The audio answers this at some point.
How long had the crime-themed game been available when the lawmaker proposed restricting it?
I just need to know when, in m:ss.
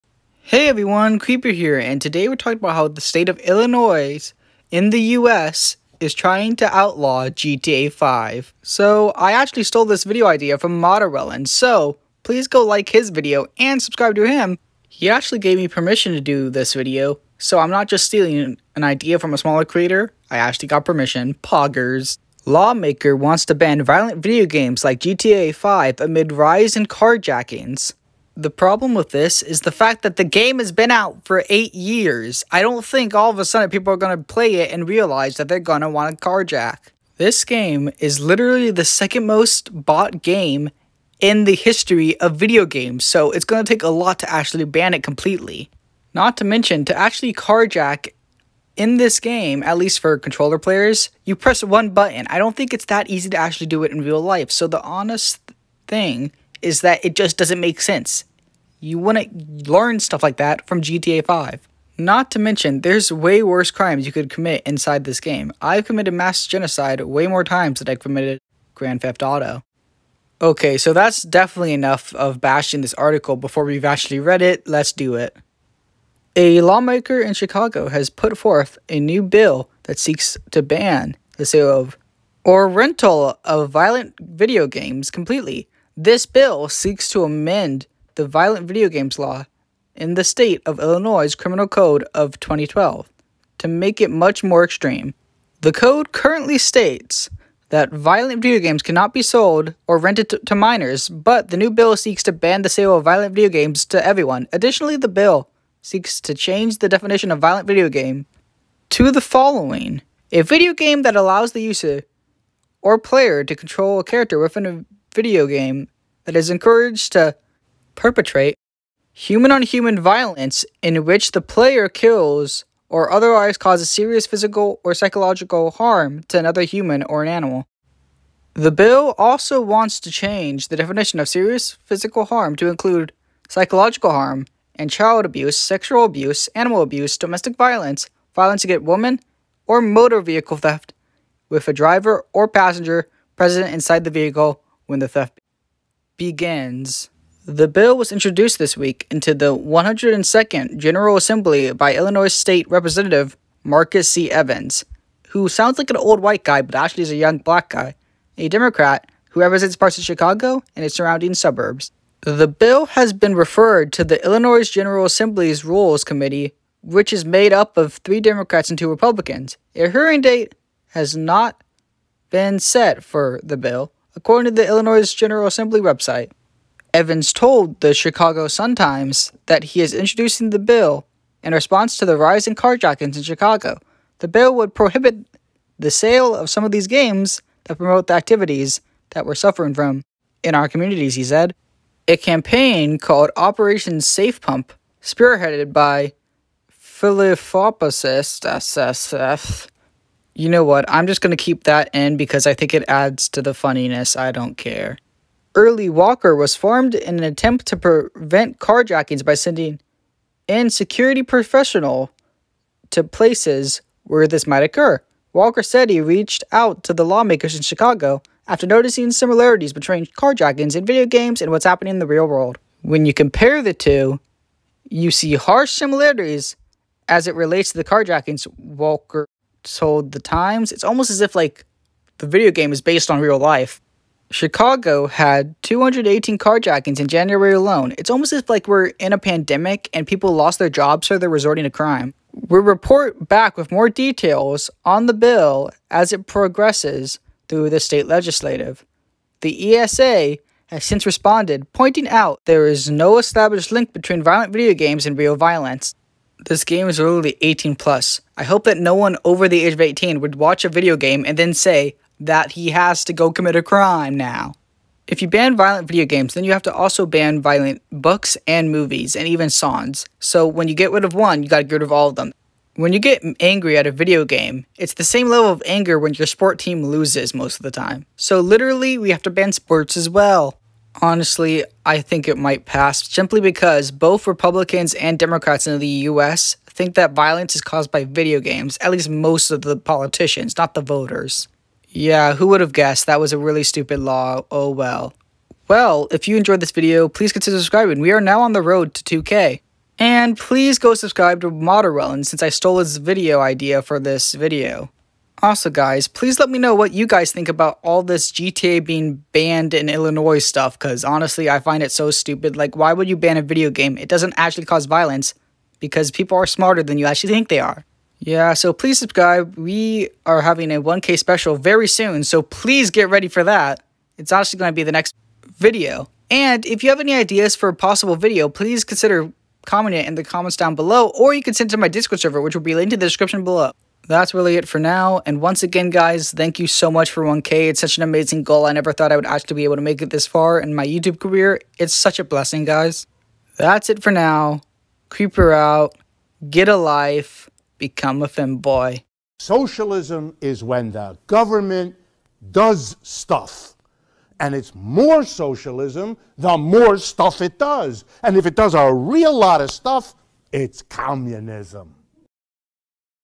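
0:31.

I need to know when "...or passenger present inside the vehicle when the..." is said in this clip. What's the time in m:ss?
2:22.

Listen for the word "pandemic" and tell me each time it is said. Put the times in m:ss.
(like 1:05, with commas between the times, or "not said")
3:59.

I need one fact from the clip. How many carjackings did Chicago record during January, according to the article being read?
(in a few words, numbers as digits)
218.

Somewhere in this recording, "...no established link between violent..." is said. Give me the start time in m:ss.
4:12.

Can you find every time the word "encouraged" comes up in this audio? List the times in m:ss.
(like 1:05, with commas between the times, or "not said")
1:56.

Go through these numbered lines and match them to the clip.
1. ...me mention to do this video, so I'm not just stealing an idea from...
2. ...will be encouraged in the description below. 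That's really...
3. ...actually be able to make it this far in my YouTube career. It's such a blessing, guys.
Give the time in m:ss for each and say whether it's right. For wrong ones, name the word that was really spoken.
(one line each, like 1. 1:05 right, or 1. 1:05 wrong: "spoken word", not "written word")
1. 0:15 wrong: "permission", not "mention"
2. 5:32 wrong: "linked", not "encouraged"
3. 5:39 right.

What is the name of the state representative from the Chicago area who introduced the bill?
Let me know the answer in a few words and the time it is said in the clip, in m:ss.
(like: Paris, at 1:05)
Marcus C. Evans, at 2:33.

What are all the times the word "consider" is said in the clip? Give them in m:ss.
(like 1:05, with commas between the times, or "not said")
4:57, 5:28.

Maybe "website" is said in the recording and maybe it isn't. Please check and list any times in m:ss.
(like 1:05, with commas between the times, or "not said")
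2:55.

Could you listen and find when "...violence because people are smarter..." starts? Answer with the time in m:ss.
5:14.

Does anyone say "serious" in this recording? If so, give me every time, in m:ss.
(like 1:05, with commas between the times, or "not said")
2:03, 2:11.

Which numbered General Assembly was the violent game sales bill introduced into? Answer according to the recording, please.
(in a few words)
102nd.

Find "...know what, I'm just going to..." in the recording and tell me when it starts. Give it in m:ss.
3:20.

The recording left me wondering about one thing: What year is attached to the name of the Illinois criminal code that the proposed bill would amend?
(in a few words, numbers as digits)
2012.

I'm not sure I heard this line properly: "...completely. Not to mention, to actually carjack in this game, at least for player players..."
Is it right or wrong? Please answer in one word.
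wrong.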